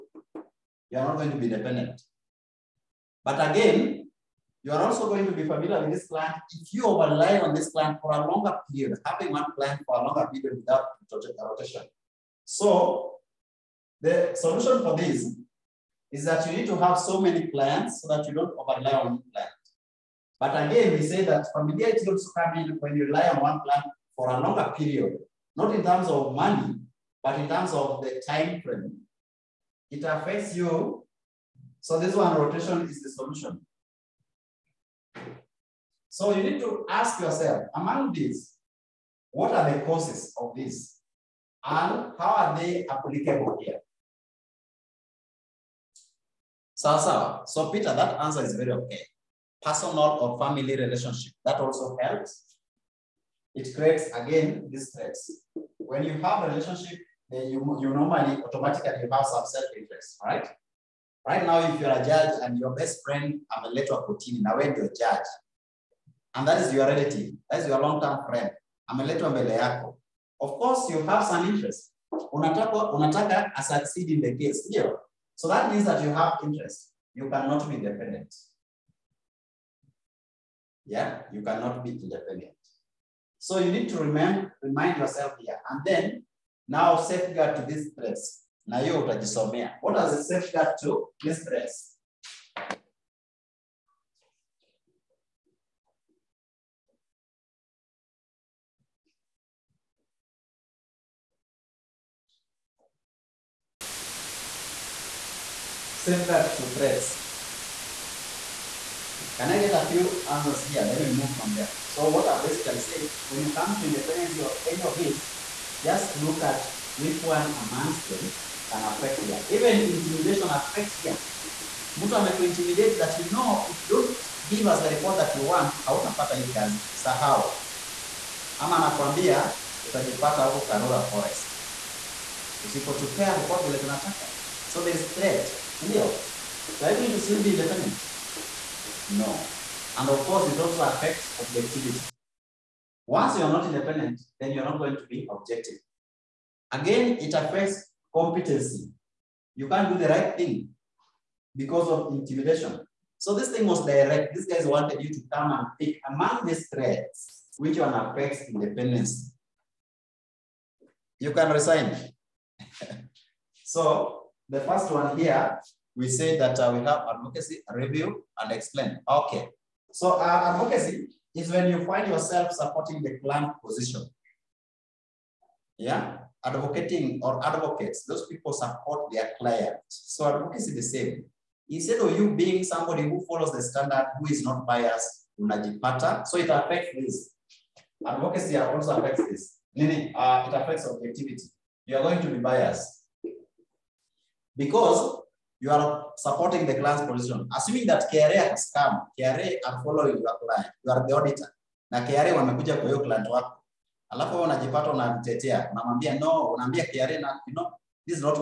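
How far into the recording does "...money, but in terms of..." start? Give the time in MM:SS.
00:26.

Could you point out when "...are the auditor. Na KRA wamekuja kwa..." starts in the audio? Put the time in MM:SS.
03:20.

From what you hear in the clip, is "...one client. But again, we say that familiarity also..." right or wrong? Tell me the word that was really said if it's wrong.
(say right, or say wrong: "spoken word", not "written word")
wrong: "plant", not "client".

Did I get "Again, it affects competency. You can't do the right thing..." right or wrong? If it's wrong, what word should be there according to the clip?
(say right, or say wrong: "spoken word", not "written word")
right.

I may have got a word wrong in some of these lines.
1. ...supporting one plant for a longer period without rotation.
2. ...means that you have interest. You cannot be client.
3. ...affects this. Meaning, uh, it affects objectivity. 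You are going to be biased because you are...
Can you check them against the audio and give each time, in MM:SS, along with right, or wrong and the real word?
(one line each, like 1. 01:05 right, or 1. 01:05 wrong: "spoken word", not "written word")
1. 00:09 wrong: "having", not "supporting"
2. 01:15 wrong: "independent", not "client"
3. 03:08 right.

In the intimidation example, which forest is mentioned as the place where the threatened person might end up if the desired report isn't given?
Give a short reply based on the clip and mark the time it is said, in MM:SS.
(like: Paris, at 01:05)
Karura Forest, at 02:10.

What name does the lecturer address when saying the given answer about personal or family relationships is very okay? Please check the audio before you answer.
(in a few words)
Peter.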